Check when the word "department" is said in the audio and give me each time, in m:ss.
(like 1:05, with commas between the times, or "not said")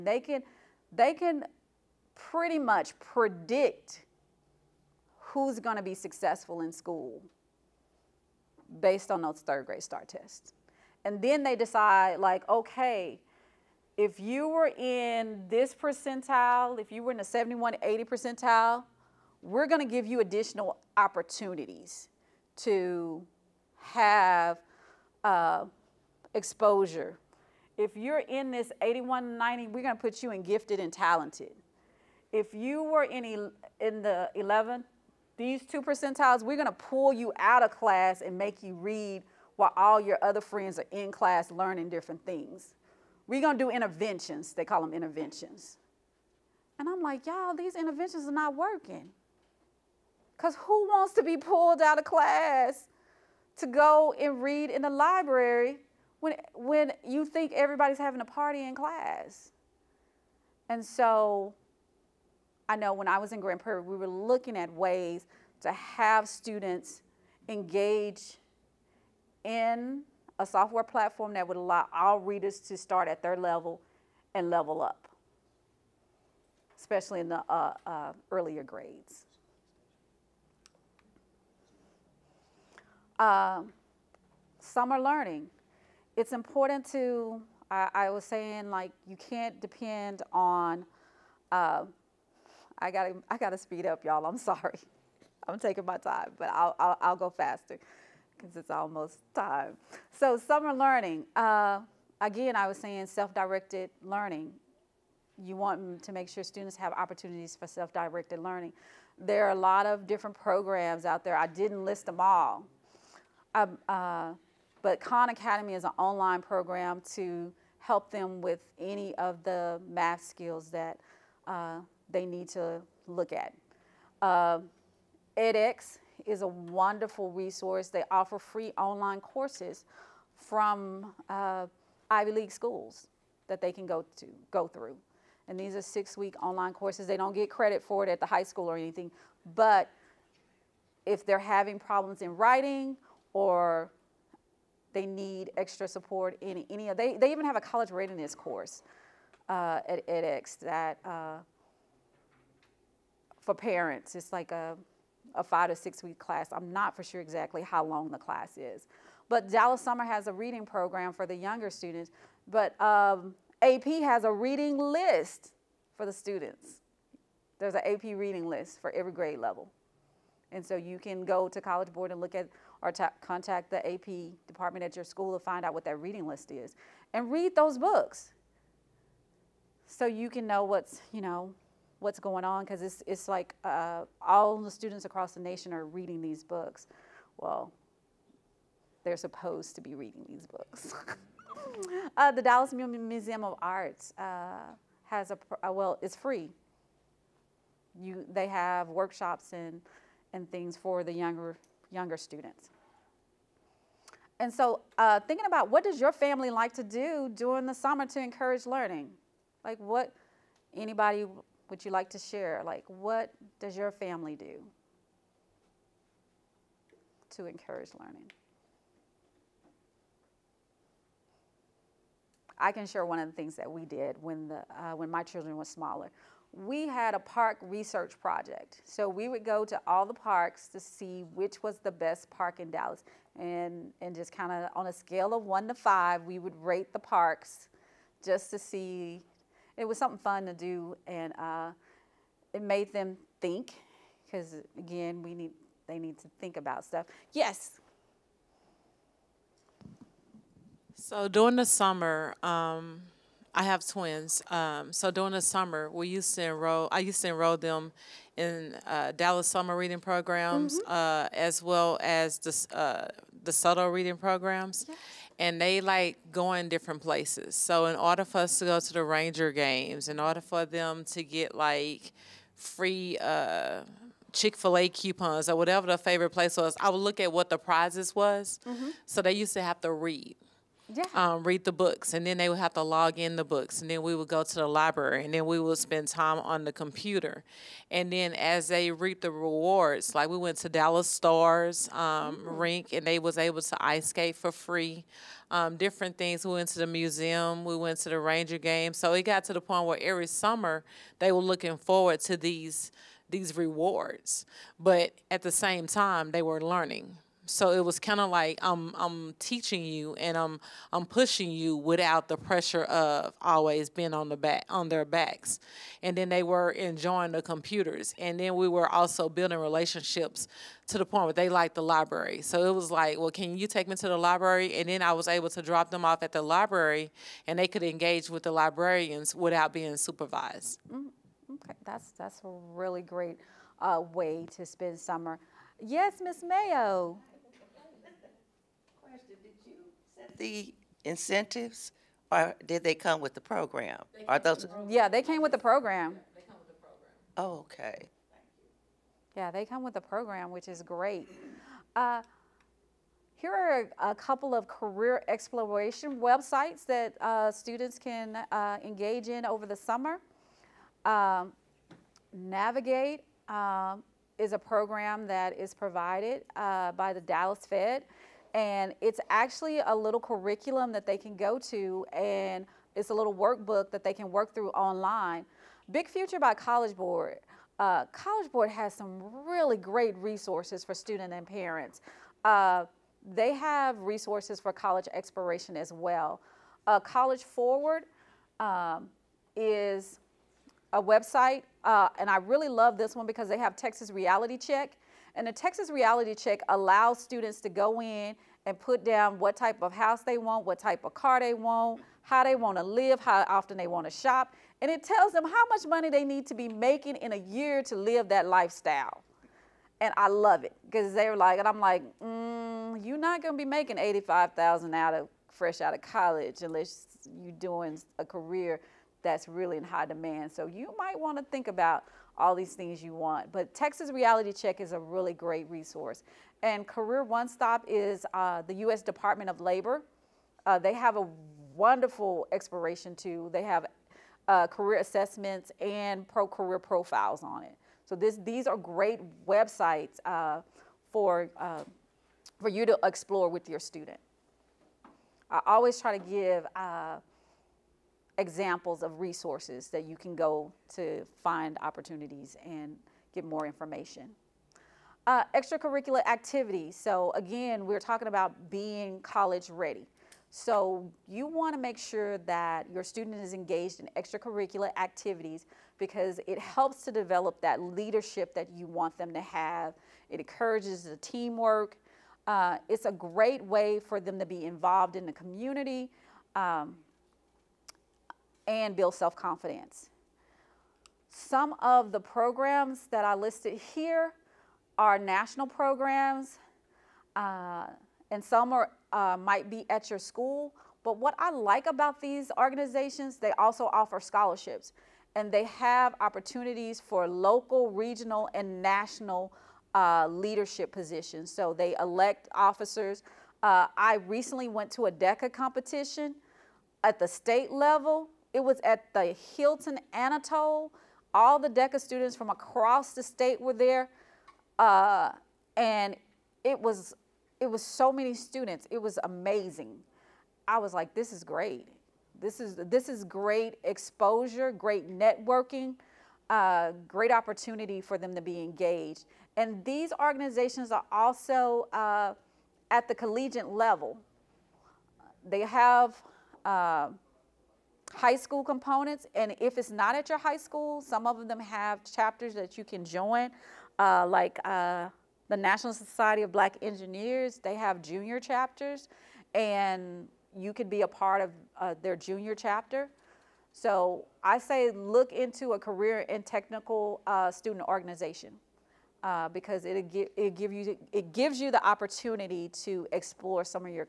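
2:54, 7:09.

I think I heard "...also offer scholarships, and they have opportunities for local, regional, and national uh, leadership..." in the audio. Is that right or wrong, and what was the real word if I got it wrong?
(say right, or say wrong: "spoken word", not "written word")
right.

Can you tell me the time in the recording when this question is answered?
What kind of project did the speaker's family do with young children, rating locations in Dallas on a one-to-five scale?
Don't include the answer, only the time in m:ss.
3:47.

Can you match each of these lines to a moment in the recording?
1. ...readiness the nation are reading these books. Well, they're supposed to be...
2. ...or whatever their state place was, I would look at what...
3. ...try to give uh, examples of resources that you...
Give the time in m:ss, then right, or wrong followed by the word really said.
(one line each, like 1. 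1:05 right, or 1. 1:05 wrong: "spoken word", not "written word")
1. 3:05 wrong: "across", not "readiness"
2. 4:35 wrong: "favorite", not "state"
3. 7:25 right.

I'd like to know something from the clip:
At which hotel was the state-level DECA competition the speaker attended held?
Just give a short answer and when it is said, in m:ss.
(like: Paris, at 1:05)
Hilton Anatole, at 8:29.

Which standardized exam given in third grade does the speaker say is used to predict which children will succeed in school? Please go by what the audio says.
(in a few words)
STAR tests.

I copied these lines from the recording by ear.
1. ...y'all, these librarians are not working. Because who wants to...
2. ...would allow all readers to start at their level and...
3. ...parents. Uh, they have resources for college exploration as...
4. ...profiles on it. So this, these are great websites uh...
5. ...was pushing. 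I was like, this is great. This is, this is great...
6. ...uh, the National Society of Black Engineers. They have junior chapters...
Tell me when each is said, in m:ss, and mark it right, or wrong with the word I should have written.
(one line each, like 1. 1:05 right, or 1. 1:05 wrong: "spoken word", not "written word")
1. 0:47 wrong: "interventions", not "librarians"
2. 1:11 right
3. 6:21 right
4. 7:16 right
5. 8:39 wrong: "amazing", not "pushing"
6. 9:04 right.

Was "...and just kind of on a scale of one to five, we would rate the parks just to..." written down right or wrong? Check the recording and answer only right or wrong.
right.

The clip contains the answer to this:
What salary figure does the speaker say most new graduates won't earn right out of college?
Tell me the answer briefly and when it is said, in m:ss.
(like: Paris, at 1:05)
85000, at 6:53.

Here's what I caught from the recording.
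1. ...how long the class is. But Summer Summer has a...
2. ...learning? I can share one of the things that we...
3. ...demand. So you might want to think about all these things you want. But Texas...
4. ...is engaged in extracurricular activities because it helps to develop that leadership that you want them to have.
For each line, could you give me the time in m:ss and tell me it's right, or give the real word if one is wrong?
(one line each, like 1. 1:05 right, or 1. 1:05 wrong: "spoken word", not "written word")
1. 2:37 wrong: "Dallas", not "Summer"
2. 3:37 right
3. 7:00 right
4. 7:43 right.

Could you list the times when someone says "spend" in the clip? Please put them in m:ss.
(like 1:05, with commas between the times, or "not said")
4:45, 5:34.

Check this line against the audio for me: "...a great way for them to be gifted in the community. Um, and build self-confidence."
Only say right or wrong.
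wrong.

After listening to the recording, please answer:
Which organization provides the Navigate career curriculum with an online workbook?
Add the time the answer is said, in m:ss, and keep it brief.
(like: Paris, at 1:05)
the Dallas Fed, at 6:07.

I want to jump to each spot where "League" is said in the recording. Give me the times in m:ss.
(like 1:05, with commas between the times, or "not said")
2:12.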